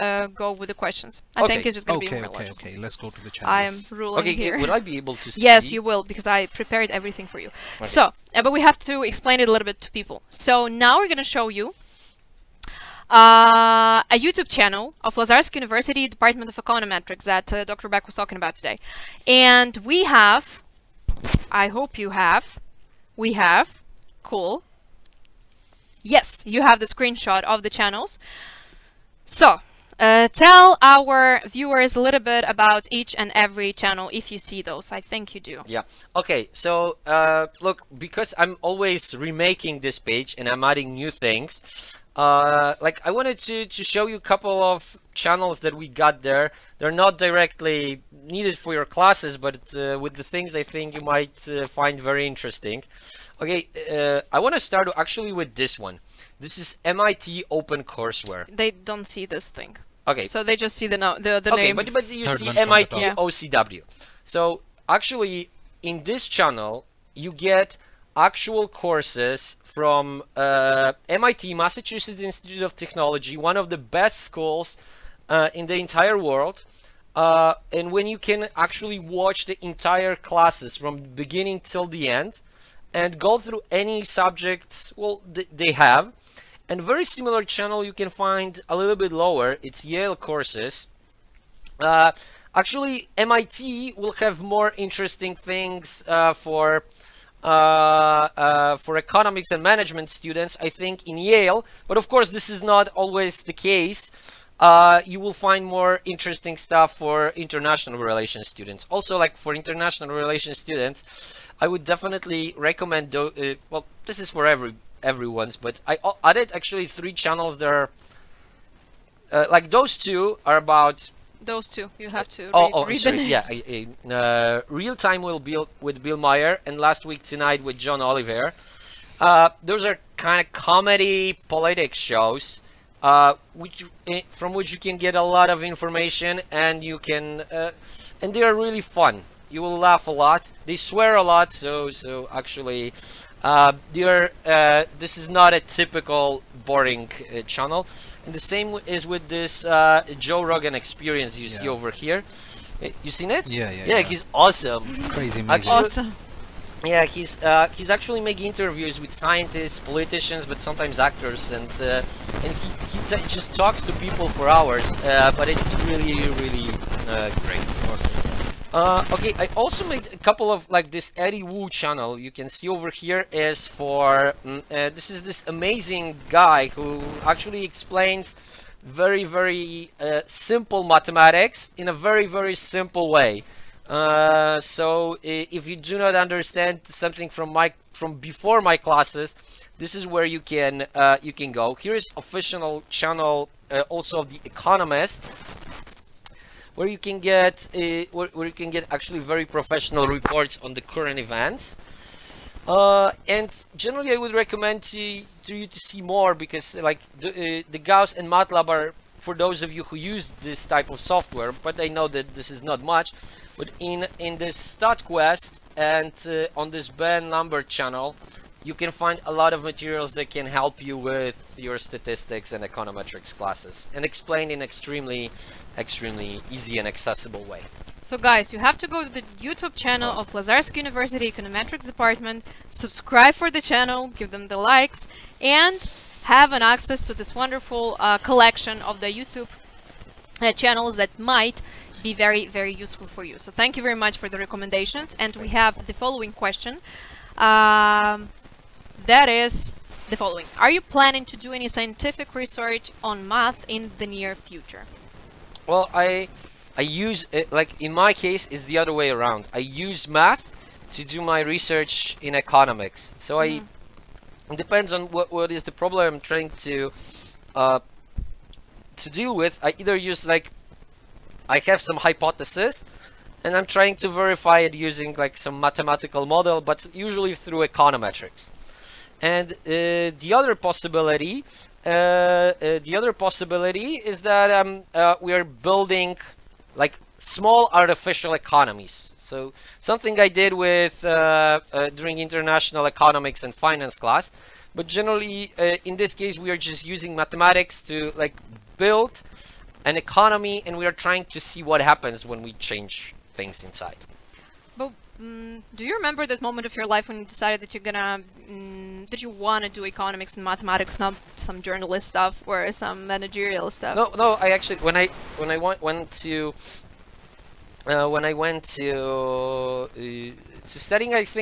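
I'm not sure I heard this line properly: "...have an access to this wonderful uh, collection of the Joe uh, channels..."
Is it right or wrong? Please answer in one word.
wrong.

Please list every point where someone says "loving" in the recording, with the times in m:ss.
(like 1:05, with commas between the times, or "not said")
not said.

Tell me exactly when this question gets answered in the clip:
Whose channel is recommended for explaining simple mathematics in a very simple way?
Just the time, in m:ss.
2:51.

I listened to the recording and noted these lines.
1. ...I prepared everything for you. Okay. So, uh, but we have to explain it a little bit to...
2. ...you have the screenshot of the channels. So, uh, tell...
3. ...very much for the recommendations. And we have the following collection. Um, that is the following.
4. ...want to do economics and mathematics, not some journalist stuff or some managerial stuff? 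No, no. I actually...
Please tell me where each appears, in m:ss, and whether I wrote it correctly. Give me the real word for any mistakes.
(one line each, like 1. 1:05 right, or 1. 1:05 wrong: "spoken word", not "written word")
1. 0:06 right
2. 0:26 right
3. 4:03 wrong: "question", not "collection"
4. 5:09 right.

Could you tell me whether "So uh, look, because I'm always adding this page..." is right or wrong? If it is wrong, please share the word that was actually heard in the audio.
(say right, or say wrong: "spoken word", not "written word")
wrong: "remaking", not "adding".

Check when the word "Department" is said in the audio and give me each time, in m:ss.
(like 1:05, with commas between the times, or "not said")
0:16, 3:51.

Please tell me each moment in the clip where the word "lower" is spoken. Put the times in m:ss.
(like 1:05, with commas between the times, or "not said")
1:29.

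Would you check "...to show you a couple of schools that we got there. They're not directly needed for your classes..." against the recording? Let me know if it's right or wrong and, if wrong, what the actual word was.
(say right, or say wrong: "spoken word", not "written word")
wrong: "channels", not "schools".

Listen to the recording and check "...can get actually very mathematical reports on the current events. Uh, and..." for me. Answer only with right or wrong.
wrong.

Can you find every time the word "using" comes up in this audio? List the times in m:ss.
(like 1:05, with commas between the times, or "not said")
4:34, 4:56.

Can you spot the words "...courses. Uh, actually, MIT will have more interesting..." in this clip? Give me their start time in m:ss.
1:30.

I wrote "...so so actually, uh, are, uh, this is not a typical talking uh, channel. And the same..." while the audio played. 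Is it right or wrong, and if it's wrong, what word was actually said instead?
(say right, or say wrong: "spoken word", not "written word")
wrong: "boring", not "talking".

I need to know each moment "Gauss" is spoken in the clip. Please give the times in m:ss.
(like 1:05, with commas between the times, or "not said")
3:27.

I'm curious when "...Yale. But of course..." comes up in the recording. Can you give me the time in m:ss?
1:41.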